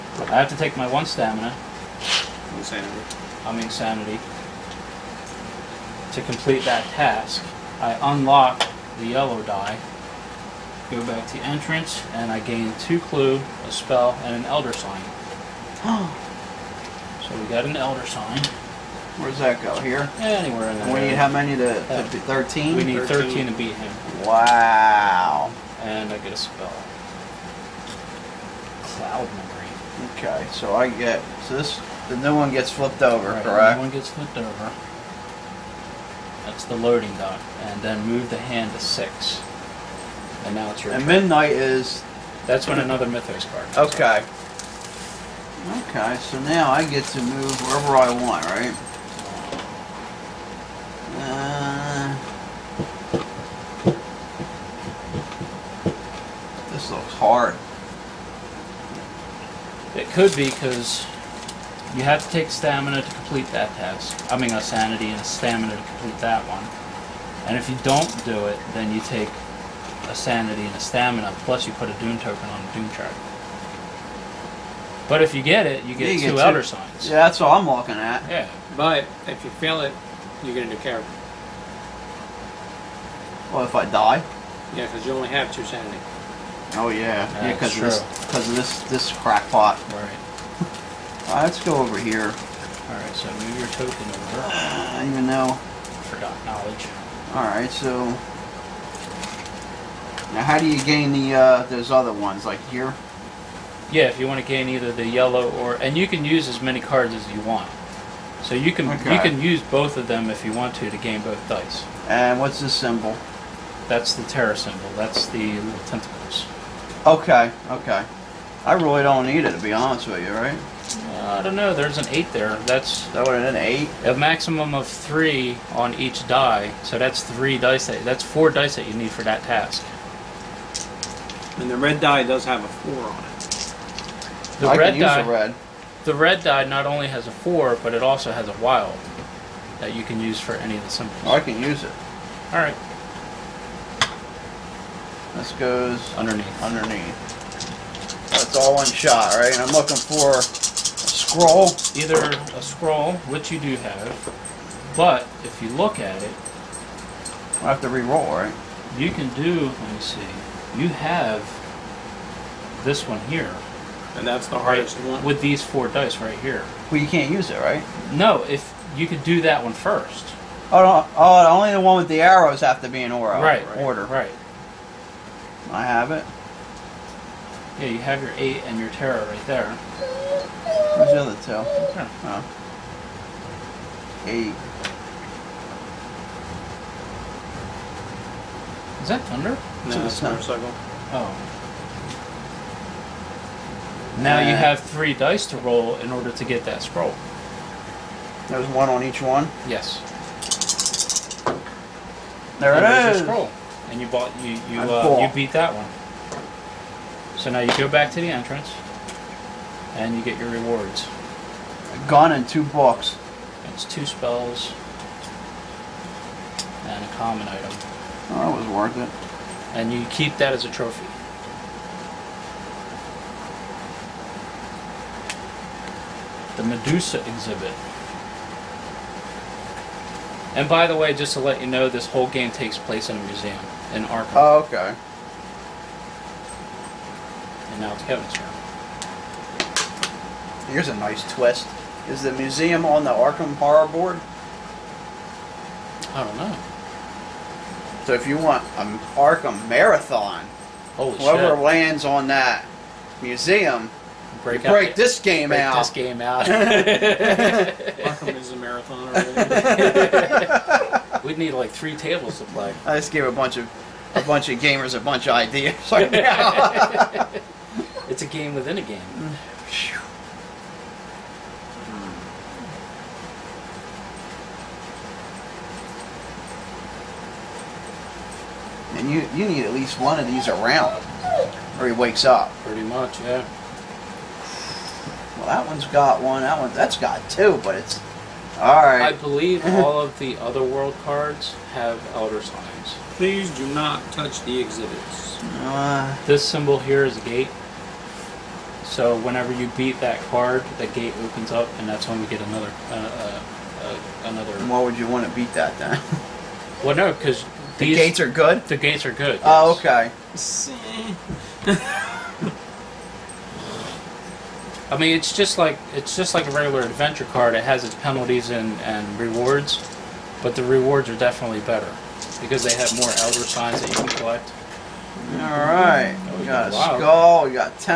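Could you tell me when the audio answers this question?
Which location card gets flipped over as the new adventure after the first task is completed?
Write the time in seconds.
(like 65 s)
36 s.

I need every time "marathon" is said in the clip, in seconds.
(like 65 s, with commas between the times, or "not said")
249 s, 258 s.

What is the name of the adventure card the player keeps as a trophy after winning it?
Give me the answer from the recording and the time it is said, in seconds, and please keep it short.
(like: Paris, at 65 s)
The Medusa exhibit, at 226 s.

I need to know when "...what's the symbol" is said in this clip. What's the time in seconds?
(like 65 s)
112 s.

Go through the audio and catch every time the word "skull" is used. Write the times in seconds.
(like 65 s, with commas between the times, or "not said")
326 s.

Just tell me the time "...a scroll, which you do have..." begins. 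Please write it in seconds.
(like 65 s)
152 s.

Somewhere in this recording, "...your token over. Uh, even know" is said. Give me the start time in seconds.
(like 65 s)
93 s.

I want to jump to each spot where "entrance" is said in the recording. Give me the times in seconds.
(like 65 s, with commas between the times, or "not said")
11 s, 208 s.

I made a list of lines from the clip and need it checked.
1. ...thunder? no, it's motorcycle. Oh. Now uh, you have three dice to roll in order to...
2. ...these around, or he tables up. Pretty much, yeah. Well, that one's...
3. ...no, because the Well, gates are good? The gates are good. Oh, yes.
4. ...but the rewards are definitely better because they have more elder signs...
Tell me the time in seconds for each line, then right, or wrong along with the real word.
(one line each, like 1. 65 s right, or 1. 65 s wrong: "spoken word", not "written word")
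1. 189 s right
2. 280 s wrong: "wakes", not "tables"
3. 306 s wrong: "These", not "Well"
4. 320 s right.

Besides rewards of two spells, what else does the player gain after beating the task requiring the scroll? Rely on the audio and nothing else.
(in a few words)
A common item.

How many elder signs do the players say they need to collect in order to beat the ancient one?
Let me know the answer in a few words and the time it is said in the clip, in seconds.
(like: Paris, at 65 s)
13, at 22 s.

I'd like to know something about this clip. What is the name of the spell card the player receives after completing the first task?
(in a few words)
Cloud memory.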